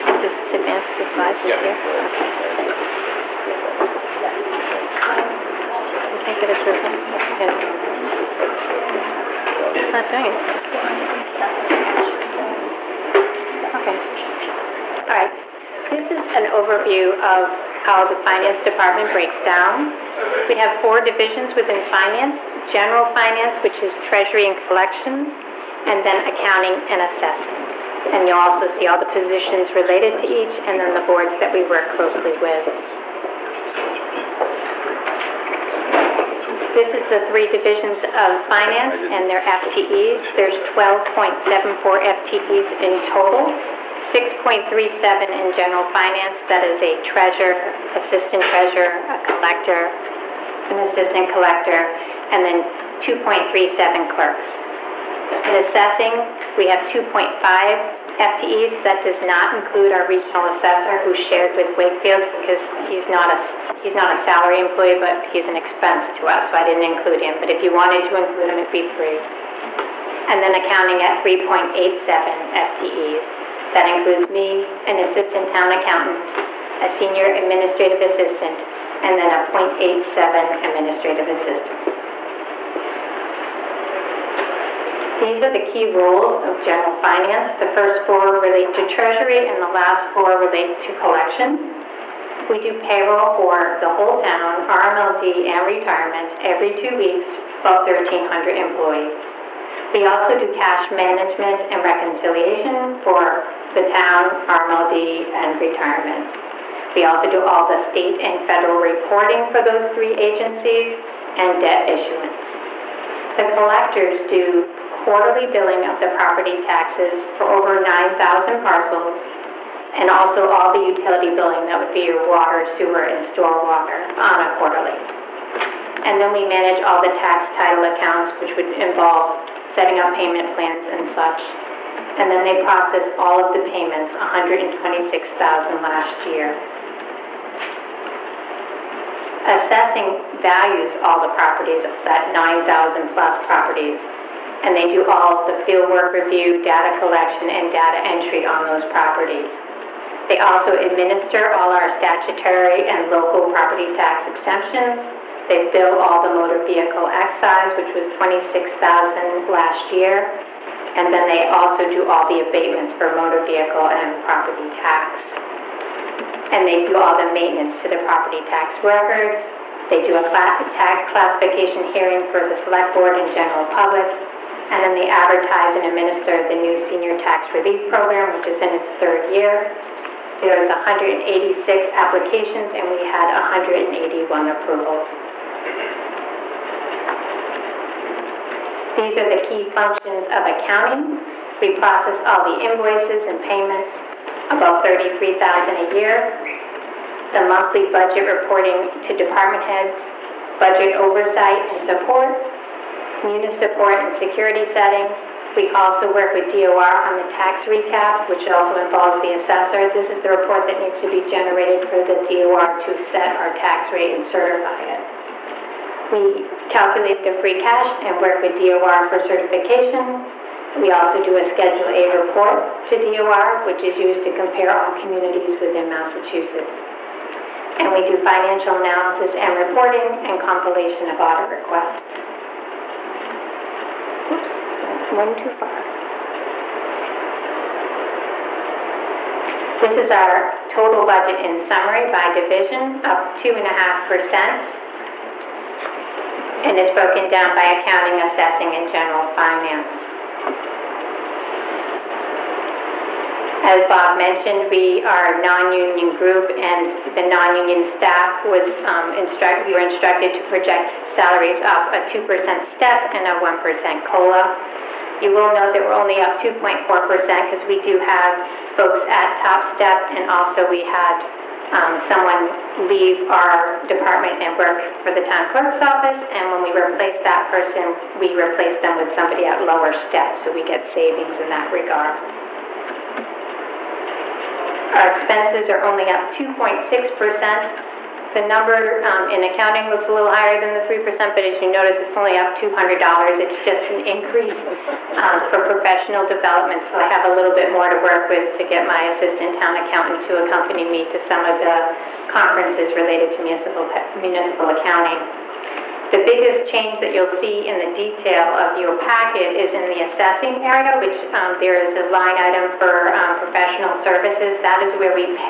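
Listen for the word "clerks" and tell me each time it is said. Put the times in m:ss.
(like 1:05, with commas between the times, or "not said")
0:54, 4:35.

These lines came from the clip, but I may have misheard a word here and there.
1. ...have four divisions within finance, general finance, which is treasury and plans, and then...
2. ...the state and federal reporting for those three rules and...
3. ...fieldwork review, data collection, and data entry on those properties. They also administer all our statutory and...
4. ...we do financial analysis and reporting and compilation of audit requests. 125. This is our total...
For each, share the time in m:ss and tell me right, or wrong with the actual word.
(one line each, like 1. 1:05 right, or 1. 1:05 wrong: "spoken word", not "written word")
1. 0:20 wrong: "collections", not "plans"
2. 1:47 wrong: "agencies", not "rules"
3. 2:25 right
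4. 3:47 right.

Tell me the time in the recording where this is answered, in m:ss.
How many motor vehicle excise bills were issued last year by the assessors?
2:38.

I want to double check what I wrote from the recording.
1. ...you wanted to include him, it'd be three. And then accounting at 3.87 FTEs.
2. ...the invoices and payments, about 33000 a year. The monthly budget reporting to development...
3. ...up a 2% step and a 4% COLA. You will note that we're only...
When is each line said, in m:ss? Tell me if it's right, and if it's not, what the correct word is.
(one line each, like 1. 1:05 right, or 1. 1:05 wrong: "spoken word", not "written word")
1. 1:07 right
2. 3:12 wrong: "department", not "development"
3. 4:21 wrong: "1", not "4".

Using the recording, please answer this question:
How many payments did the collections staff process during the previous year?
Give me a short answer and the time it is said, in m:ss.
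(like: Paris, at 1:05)
126,000, at 2:14.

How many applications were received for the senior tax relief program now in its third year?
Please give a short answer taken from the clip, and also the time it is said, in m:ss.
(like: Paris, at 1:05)
186, at 3:00.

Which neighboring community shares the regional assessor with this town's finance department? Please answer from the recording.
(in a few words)
Wakefield.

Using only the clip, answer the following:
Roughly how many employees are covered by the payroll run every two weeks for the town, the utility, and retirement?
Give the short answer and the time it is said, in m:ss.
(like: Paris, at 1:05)
1,300, at 1:37.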